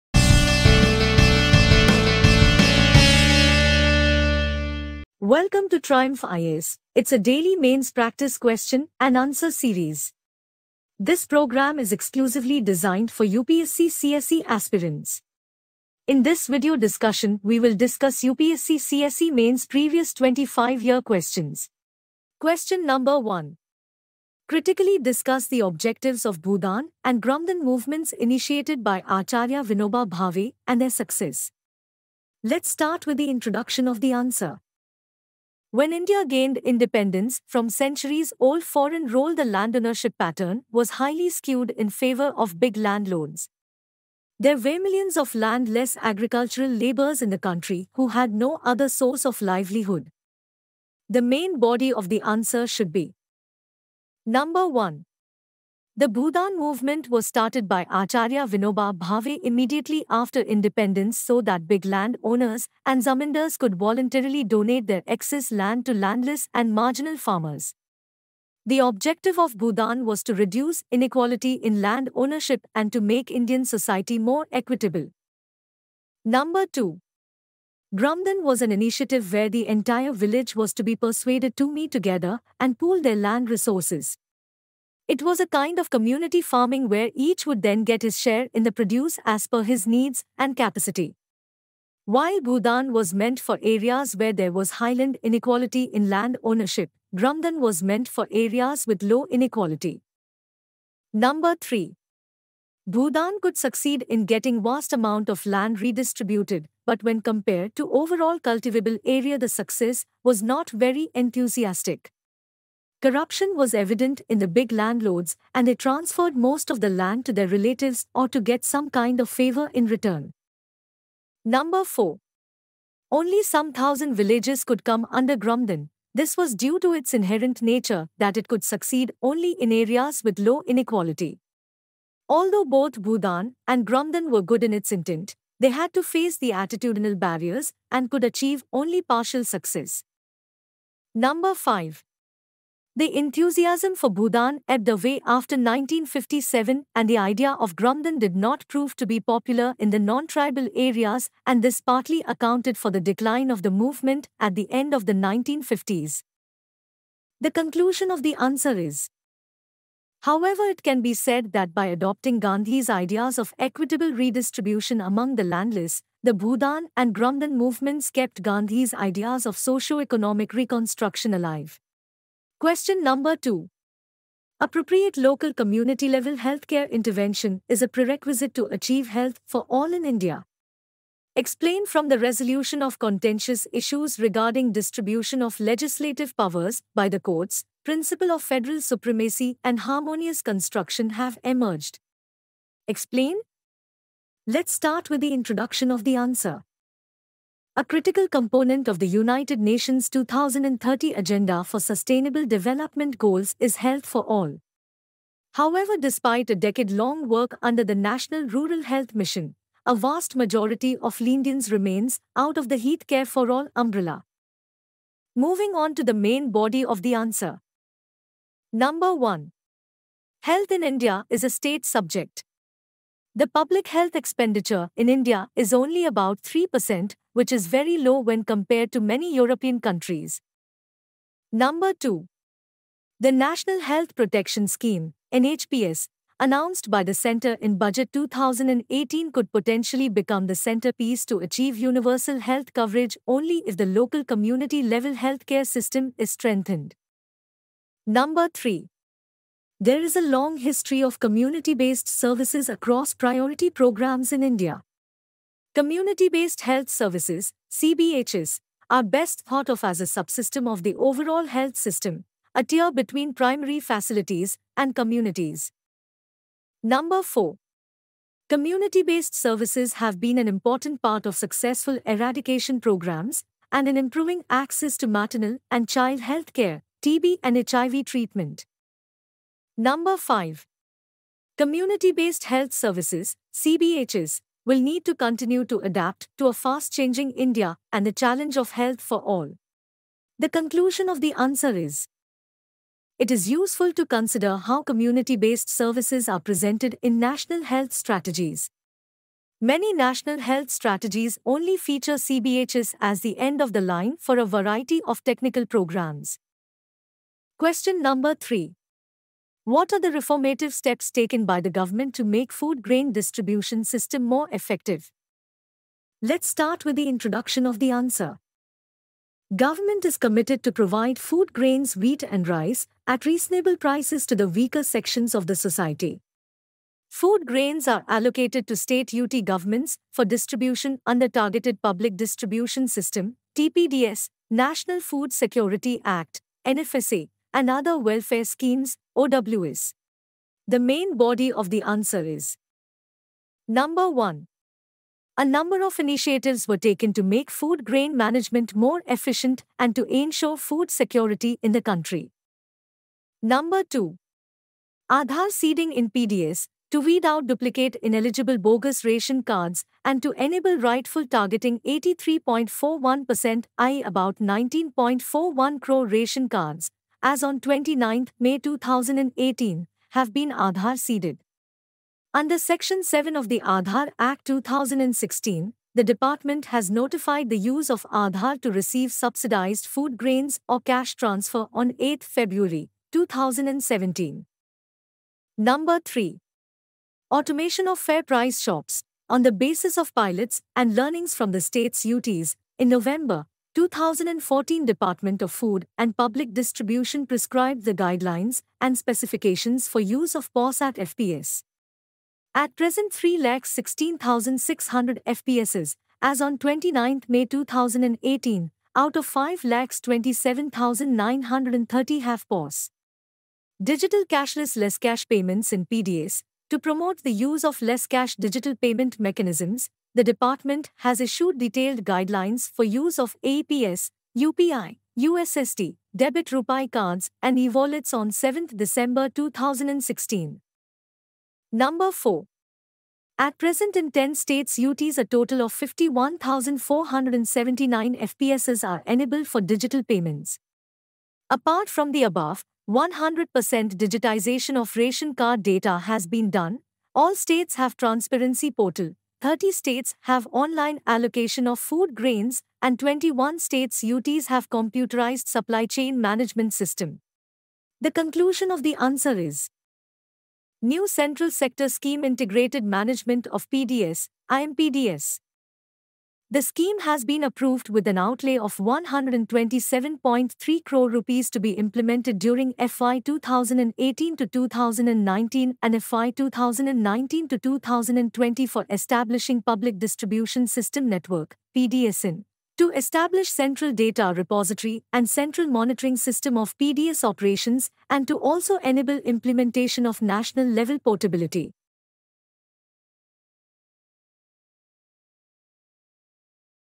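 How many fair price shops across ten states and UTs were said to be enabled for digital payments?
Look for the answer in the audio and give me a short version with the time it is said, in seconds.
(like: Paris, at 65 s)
51,479, at 435 s.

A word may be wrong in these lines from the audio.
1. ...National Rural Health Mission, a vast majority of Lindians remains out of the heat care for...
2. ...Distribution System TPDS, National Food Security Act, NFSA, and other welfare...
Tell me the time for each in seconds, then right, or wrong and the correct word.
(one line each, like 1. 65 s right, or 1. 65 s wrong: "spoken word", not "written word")
1. 207 s right
2. 332 s right.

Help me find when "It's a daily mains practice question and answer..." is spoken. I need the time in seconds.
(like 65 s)
6 s.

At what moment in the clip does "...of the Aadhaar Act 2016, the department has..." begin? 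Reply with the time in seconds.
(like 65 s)
373 s.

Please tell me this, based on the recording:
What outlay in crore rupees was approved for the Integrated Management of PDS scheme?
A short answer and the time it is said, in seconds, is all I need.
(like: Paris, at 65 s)
127.3 crore, at 468 s.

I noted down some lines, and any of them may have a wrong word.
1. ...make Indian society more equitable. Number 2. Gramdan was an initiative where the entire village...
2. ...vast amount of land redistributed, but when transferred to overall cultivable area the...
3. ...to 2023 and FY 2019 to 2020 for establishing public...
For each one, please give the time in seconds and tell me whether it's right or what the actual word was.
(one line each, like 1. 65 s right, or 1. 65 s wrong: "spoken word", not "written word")
1. 73 s right
2. 104 s wrong: "compared", not "transferred"
3. 474 s wrong: "2019", not "2023".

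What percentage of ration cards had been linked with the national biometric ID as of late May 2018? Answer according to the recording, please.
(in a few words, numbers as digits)
83.41%.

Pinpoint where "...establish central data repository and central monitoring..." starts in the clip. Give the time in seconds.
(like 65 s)
482 s.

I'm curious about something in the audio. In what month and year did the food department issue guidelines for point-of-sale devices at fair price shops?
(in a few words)
November 2014.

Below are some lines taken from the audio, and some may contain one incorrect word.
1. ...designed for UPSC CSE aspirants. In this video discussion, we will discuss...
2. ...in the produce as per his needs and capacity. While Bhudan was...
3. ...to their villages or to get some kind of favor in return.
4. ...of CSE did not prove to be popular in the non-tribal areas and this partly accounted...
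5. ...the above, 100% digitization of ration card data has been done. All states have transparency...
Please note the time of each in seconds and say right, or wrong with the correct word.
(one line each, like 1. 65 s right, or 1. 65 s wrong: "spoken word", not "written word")
1. 12 s right
2. 88 s right
3. 117 s wrong: "relatives", not "villages"
4. 147 s wrong: "Gramdan", not "CSE"
5. 442 s right.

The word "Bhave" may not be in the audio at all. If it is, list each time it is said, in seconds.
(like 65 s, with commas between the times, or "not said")
30 s, 58 s.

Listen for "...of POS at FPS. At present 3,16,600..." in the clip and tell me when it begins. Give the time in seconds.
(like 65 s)
400 s.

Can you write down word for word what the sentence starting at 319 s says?
Government is committed to provide food grains, wheat and rice at reasonable prices to the weaker sections of the society.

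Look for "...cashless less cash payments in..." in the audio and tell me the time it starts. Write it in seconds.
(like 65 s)
414 s.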